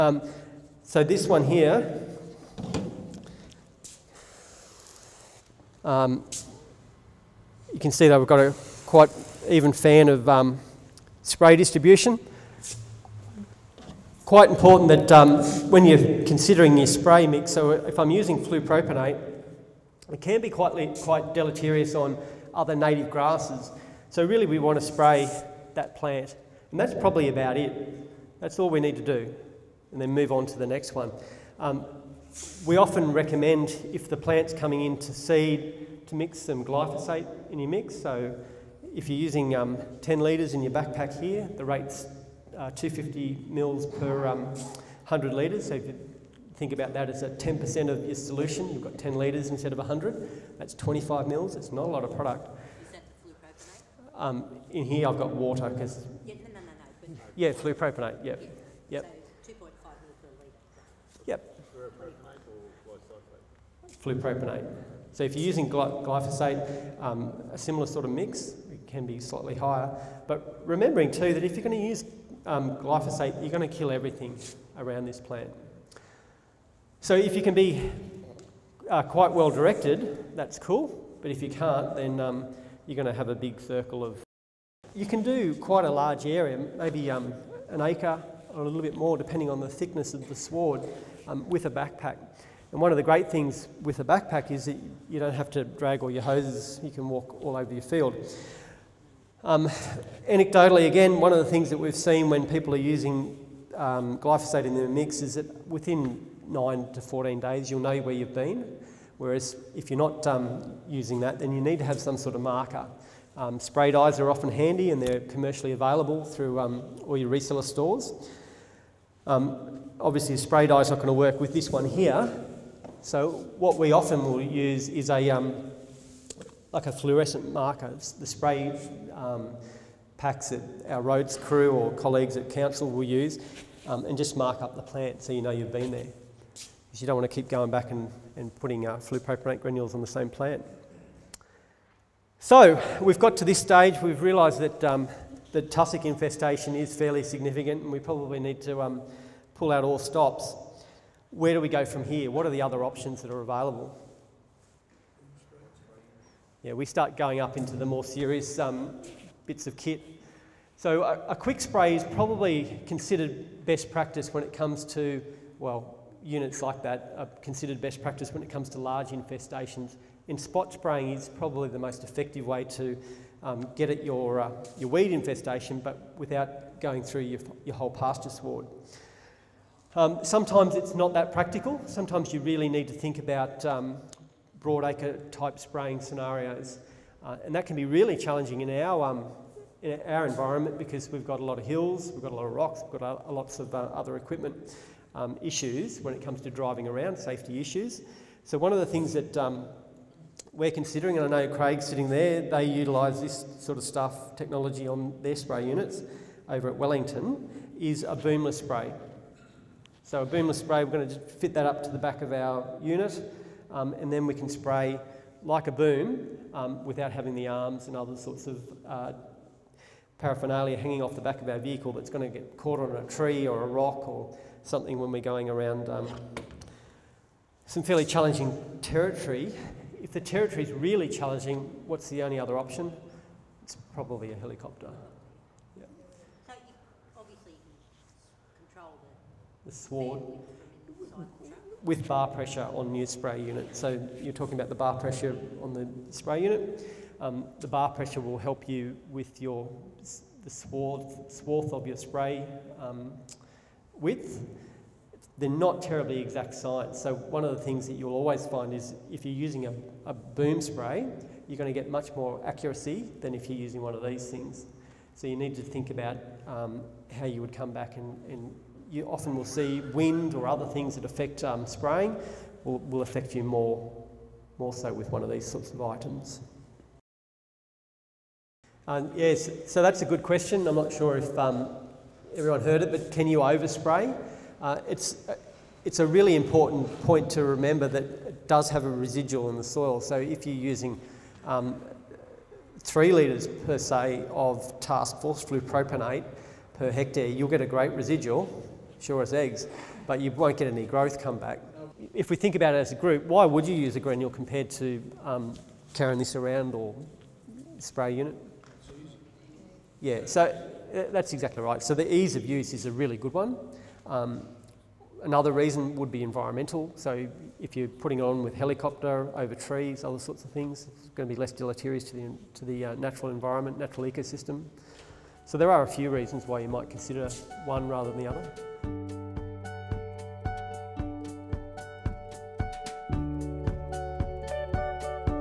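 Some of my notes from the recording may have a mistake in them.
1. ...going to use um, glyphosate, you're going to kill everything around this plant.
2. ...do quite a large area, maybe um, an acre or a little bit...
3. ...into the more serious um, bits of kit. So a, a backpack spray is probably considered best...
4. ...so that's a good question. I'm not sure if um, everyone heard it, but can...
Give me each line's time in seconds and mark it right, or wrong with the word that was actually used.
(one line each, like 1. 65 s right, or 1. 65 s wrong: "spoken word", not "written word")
1. 71 s right
2. 85 s right
3. 157 s wrong: "quick", not "backpack"
4. 279 s right.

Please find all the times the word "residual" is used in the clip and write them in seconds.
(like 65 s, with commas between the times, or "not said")
288 s, 297 s.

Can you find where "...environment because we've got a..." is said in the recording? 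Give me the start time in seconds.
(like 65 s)
190 s.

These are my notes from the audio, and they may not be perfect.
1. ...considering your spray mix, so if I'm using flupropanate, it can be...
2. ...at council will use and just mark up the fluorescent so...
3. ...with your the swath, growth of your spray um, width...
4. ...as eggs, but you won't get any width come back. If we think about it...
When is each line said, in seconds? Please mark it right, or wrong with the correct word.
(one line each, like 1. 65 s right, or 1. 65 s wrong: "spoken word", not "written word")
1. 16 s right
2. 132 s wrong: "plant", not "fluorescent"
3. 249 s wrong: "swath", not "growth"
4. 299 s wrong: "growth", not "width".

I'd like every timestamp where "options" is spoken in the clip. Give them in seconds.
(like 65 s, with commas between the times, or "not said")
152 s, 232 s.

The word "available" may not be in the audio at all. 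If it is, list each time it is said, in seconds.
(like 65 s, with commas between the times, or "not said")
115 s, 153 s.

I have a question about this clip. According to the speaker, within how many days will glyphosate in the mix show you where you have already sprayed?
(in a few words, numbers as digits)
9 to 14 days.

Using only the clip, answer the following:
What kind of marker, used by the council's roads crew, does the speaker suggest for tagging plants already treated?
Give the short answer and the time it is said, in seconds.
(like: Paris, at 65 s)
fluorescent marker, at 126 s.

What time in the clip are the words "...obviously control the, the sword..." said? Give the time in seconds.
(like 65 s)
237 s.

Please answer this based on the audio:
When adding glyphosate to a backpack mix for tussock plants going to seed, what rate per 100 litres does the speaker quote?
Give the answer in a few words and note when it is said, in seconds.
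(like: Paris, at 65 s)
250 ml, at 42 s.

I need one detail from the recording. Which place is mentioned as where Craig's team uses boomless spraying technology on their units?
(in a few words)
Wellington.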